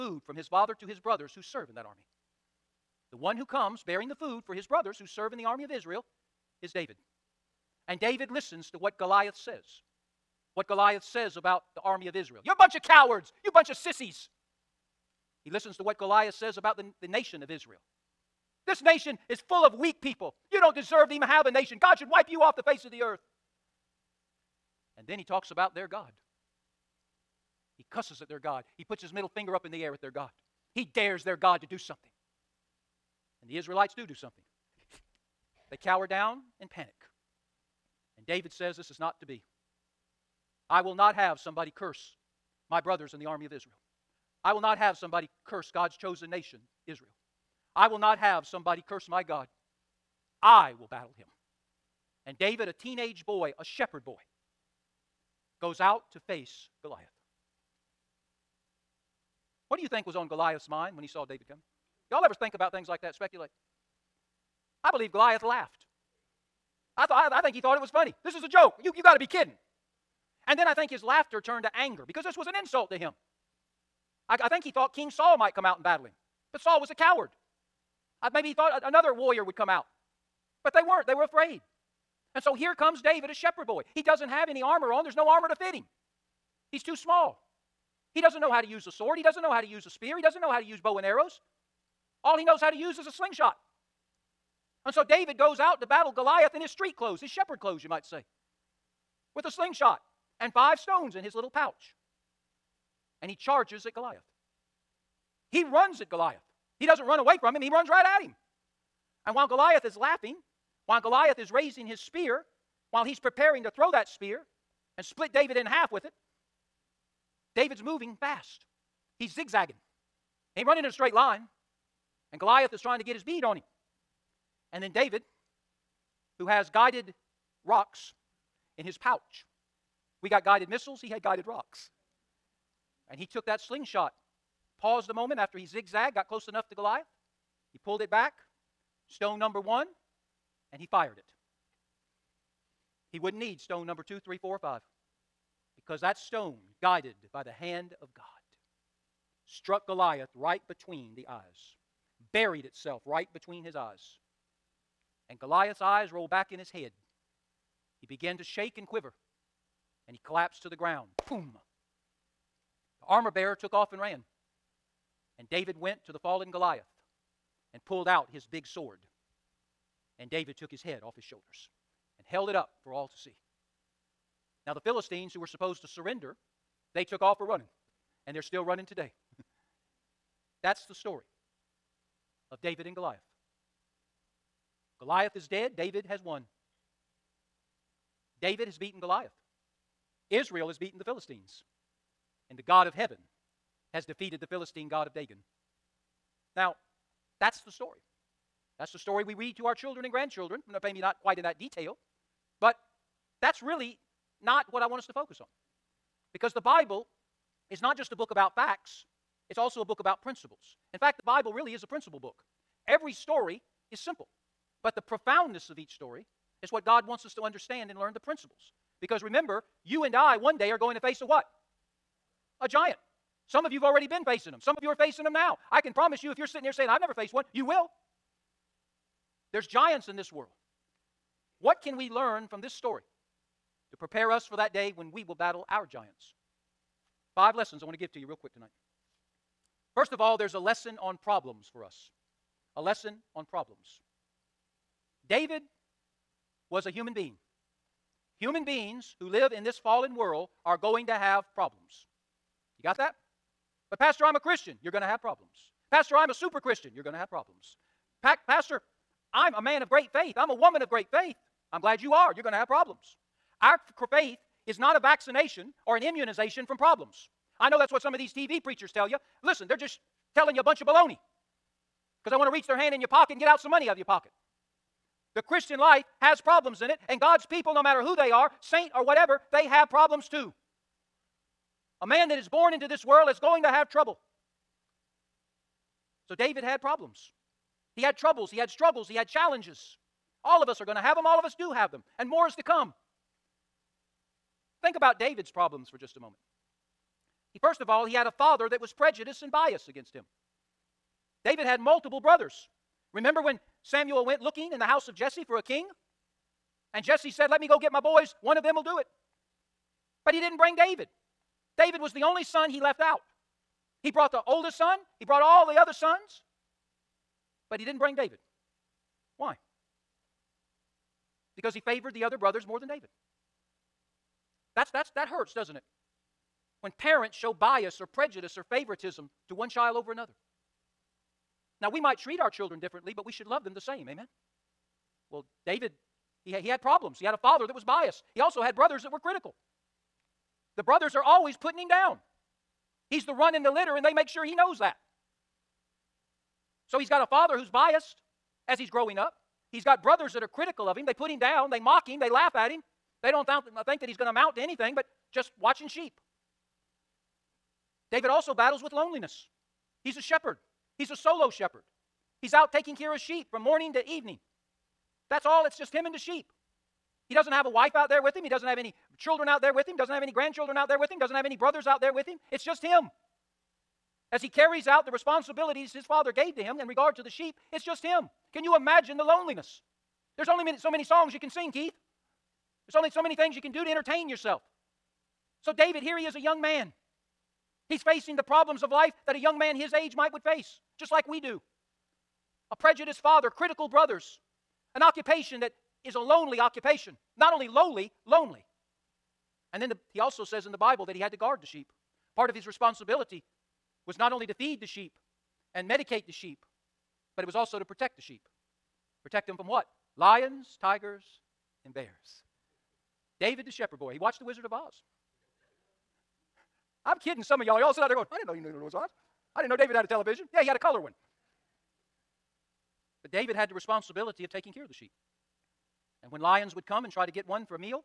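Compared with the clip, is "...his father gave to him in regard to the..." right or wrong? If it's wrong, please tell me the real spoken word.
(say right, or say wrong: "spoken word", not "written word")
right.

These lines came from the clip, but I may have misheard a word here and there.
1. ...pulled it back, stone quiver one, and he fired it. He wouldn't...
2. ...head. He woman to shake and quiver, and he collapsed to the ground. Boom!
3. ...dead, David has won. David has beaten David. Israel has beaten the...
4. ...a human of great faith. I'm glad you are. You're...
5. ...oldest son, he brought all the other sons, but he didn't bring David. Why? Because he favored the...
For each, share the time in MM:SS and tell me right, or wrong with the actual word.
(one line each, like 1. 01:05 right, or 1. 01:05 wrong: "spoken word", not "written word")
1. 02:17 wrong: "number", not "quiver"
2. 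02:36 wrong: "began", not "woman"
3. 03:05 wrong: "Goliath", not "David"
4. 04:20 wrong: "woman", not "human"
5. 05:14 right.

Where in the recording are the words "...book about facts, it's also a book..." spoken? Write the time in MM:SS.
03:28.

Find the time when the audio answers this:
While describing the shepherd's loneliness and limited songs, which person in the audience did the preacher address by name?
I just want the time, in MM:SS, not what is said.
06:21.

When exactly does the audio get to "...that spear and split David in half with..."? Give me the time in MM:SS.
01:53.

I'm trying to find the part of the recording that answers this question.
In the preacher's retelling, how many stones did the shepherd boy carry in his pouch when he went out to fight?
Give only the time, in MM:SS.
01:40.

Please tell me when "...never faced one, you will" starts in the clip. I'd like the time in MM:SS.
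03:47.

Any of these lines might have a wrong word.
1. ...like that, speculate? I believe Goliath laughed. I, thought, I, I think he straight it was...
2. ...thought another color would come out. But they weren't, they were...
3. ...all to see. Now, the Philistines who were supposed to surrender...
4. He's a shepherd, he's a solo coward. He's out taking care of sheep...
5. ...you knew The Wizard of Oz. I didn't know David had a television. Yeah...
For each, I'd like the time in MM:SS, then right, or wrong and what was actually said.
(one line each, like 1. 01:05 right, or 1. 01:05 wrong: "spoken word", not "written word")
1. 01:02 wrong: "thought", not "straight"
2. 01:18 wrong: "warrior", not "color"
3. 02:52 right
4. 06:00 wrong: "shepherd", not "coward"
5. 06:58 right.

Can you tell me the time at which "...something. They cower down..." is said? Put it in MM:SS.
00:34.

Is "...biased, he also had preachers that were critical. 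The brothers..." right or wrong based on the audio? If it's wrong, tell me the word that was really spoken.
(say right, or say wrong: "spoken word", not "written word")
wrong: "brothers", not "preachers".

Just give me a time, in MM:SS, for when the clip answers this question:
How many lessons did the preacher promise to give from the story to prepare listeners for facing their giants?
03:57.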